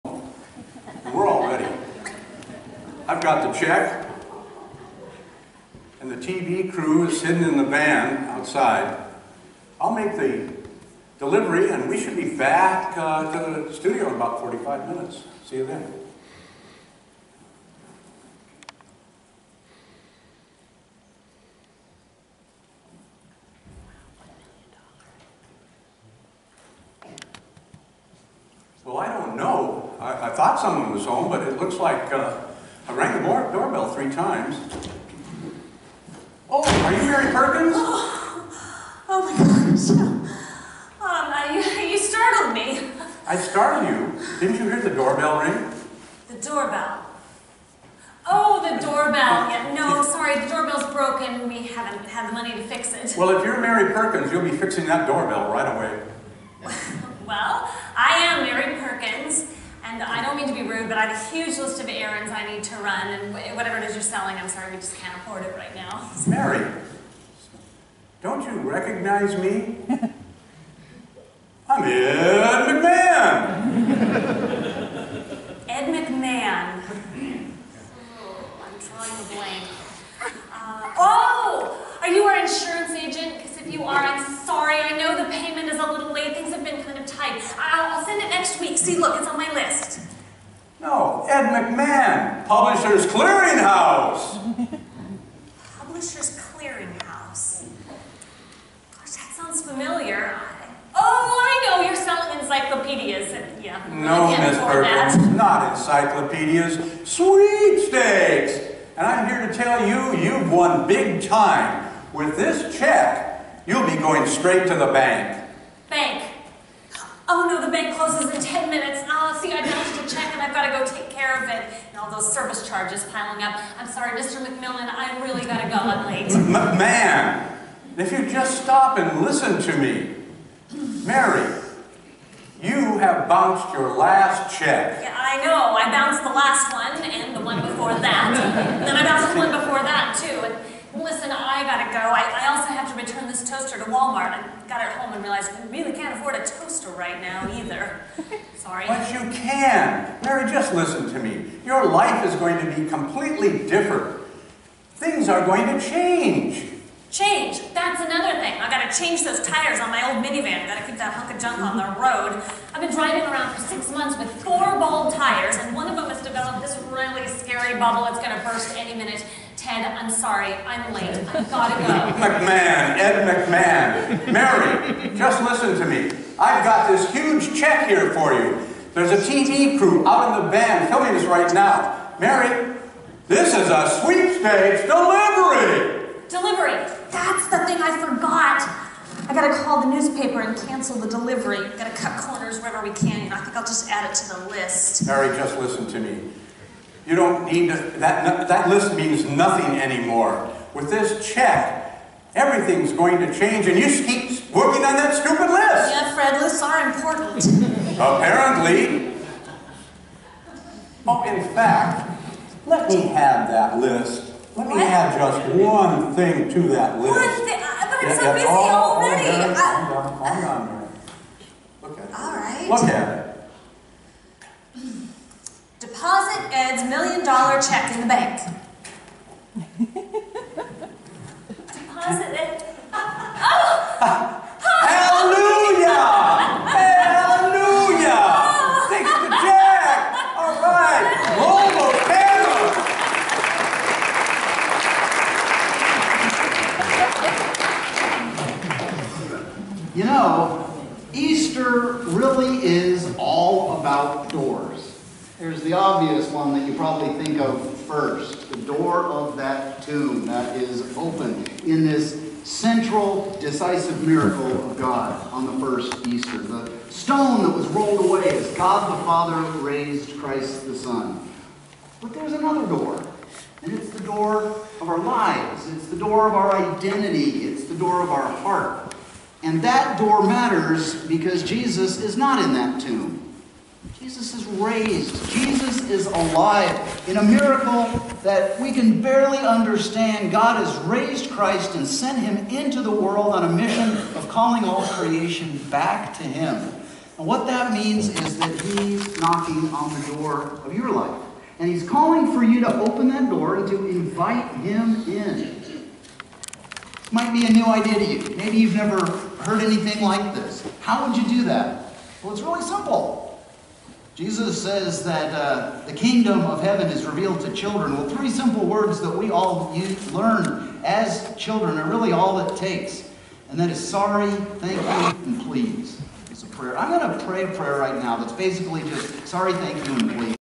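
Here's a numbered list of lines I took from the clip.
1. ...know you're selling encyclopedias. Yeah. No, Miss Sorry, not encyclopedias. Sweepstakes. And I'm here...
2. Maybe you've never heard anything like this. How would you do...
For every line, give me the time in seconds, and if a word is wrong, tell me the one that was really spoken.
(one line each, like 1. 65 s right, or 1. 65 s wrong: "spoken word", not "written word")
1. 101 s wrong: "Perkins", not "Sorry"
2. 308 s right.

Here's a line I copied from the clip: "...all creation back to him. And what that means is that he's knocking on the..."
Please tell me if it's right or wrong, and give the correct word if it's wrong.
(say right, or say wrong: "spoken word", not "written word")
right.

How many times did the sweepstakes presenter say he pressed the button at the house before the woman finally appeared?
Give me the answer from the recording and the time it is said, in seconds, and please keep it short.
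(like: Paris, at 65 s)
3, at 33 s.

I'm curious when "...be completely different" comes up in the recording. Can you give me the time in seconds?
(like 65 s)
152 s.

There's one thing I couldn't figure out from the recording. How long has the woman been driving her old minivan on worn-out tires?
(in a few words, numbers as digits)
6 months.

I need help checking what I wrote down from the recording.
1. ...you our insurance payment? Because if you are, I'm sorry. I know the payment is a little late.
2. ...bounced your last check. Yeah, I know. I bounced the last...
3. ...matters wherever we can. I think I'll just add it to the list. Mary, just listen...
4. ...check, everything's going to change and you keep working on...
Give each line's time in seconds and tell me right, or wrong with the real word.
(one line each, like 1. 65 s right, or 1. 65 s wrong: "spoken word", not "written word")
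1. 82 s wrong: "agent", not "payment"
2. 133 s right
3. 192 s wrong: "corners", not "matters"
4. 201 s right.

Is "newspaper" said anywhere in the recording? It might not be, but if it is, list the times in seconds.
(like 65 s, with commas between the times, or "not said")
189 s.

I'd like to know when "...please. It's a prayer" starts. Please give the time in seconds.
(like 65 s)
325 s.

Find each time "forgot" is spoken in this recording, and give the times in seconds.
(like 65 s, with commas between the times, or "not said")
188 s.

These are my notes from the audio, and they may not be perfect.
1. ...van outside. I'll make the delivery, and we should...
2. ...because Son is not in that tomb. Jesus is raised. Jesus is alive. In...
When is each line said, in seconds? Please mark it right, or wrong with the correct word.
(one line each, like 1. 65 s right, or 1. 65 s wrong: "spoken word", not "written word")
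1. 7 s right
2. 281 s wrong: "Jesus", not "Son".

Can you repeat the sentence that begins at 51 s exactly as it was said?
We haven't had the money to fix it.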